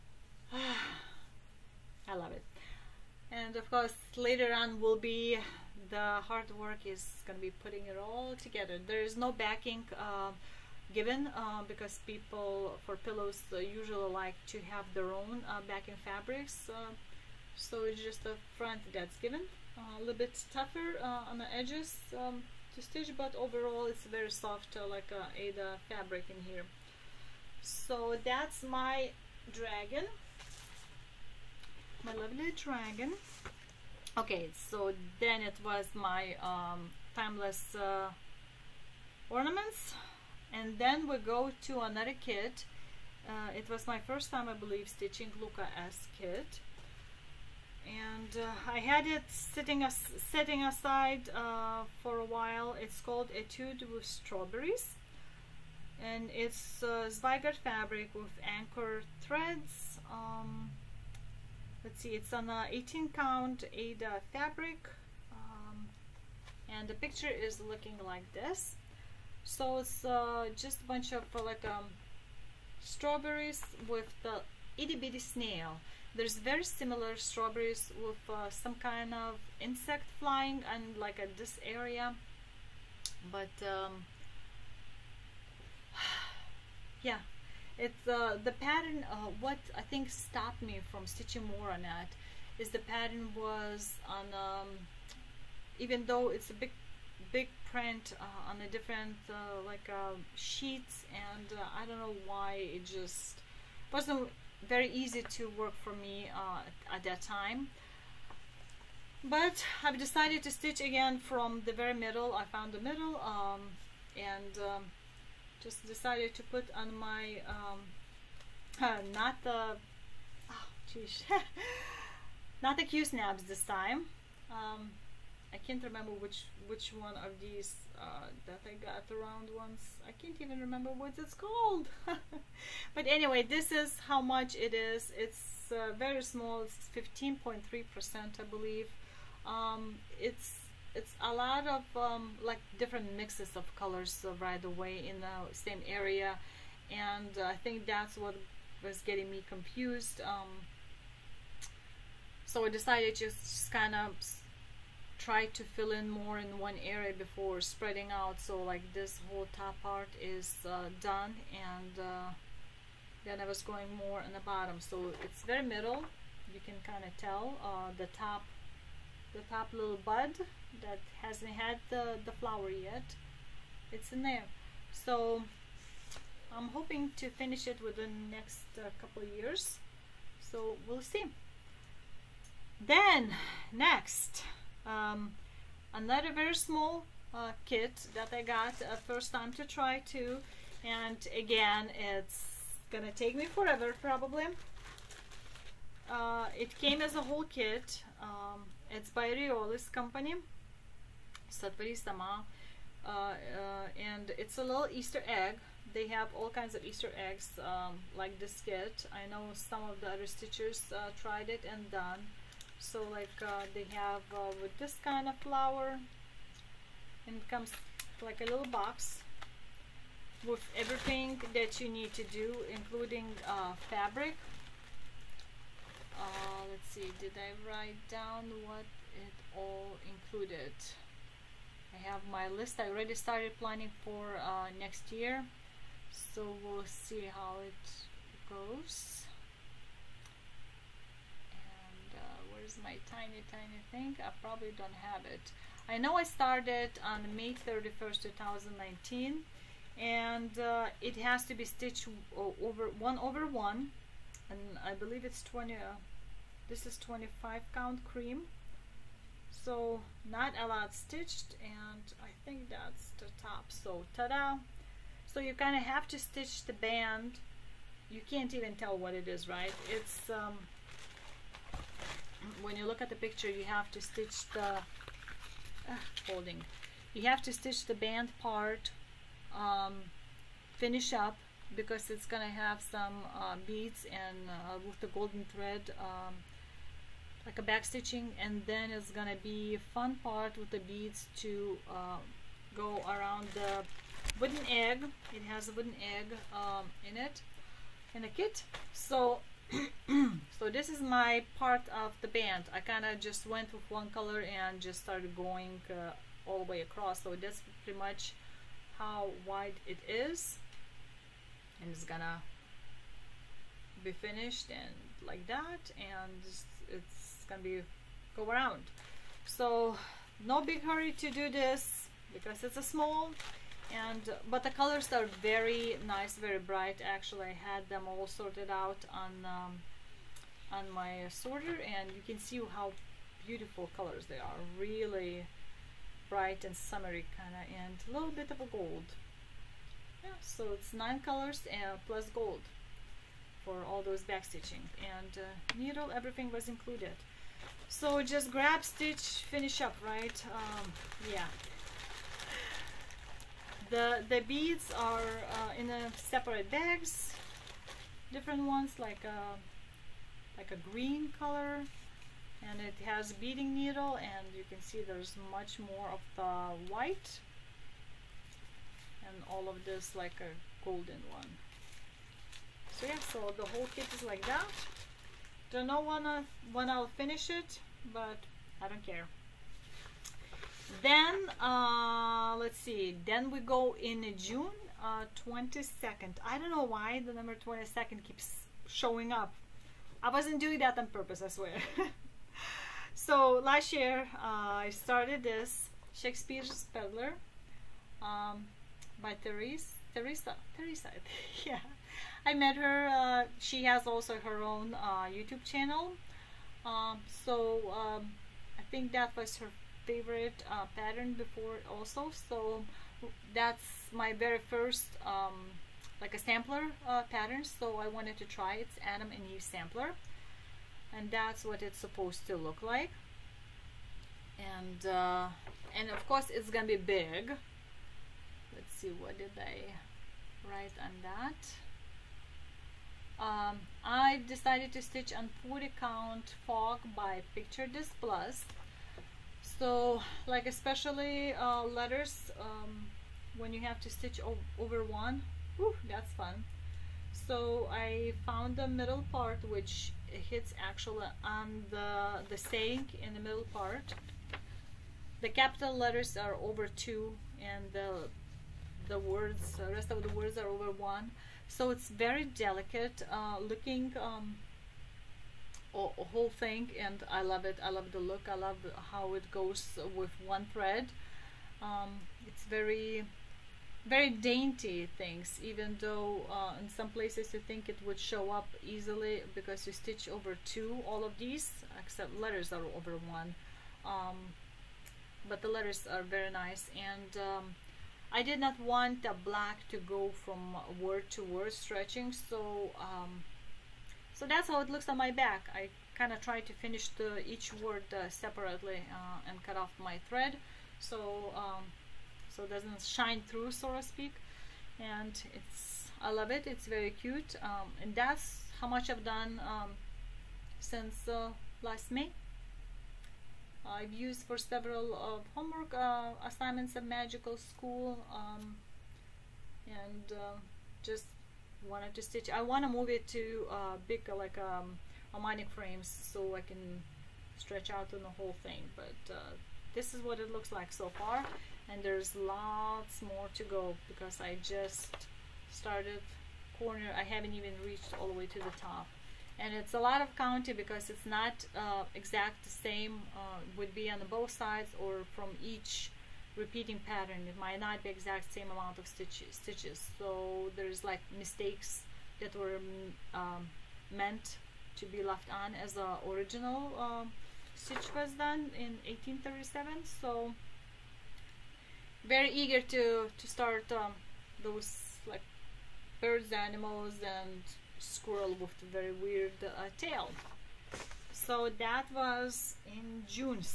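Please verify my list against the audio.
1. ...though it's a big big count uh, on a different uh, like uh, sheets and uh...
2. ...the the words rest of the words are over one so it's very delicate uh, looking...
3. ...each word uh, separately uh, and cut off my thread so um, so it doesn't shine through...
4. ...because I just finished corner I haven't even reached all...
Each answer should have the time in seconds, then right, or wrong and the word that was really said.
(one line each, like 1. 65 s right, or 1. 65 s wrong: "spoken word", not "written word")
1. 96 s wrong: "print", not "count"
2. 457 s right
3. 497 s right
4. 534 s wrong: "started", not "finished".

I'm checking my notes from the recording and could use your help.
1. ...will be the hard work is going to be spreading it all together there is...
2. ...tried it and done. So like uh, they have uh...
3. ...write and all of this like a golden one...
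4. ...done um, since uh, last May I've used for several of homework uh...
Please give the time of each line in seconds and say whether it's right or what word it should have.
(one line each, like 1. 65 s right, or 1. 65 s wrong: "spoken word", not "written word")
1. 4 s wrong: "putting", not "spreading"
2. 211 s right
3. 366 s wrong: "white", not "write"
4. 509 s right.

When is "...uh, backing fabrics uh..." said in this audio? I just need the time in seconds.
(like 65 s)
15 s.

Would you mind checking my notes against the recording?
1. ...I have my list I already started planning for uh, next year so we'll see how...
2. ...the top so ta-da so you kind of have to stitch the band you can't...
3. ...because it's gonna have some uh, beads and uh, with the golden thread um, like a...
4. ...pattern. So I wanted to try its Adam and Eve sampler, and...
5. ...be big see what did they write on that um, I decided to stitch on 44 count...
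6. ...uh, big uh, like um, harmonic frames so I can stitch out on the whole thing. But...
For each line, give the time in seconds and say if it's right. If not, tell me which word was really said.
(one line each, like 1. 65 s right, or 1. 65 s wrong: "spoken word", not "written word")
1. 231 s right
2. 263 s right
3. 281 s right
4. 417 s right
5. 426 s wrong: "40", not "44"
6. 523 s wrong: "stretch", not "stitch".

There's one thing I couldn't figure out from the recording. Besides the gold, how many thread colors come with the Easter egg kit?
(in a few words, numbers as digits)
9.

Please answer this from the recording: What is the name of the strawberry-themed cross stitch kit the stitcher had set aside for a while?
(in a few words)
Etude with Strawberries.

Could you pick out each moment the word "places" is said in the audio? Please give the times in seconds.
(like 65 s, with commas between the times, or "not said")
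477 s.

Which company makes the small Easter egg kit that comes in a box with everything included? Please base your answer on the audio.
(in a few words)
Riolis.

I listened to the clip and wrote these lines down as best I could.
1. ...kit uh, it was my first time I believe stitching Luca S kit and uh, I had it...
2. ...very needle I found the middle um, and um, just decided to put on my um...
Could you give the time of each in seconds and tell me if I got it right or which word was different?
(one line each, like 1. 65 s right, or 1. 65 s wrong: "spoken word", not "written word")
1. 42 s right
2. 111 s wrong: "middle", not "needle".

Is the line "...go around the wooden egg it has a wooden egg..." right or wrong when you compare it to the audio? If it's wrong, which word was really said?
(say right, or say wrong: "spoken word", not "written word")
right.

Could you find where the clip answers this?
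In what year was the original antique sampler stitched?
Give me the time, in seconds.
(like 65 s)
559 s.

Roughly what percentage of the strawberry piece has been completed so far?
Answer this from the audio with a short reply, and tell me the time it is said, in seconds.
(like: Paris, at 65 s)
15.3 percent, at 136 s.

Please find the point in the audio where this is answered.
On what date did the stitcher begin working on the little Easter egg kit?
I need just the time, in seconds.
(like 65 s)
247 s.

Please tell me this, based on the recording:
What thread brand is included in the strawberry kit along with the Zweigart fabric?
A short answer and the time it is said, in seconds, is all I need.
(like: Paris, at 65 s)
Anchor, at 58 s.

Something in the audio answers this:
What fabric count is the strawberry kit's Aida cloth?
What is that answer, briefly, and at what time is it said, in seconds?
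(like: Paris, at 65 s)
18 count, at 62 s.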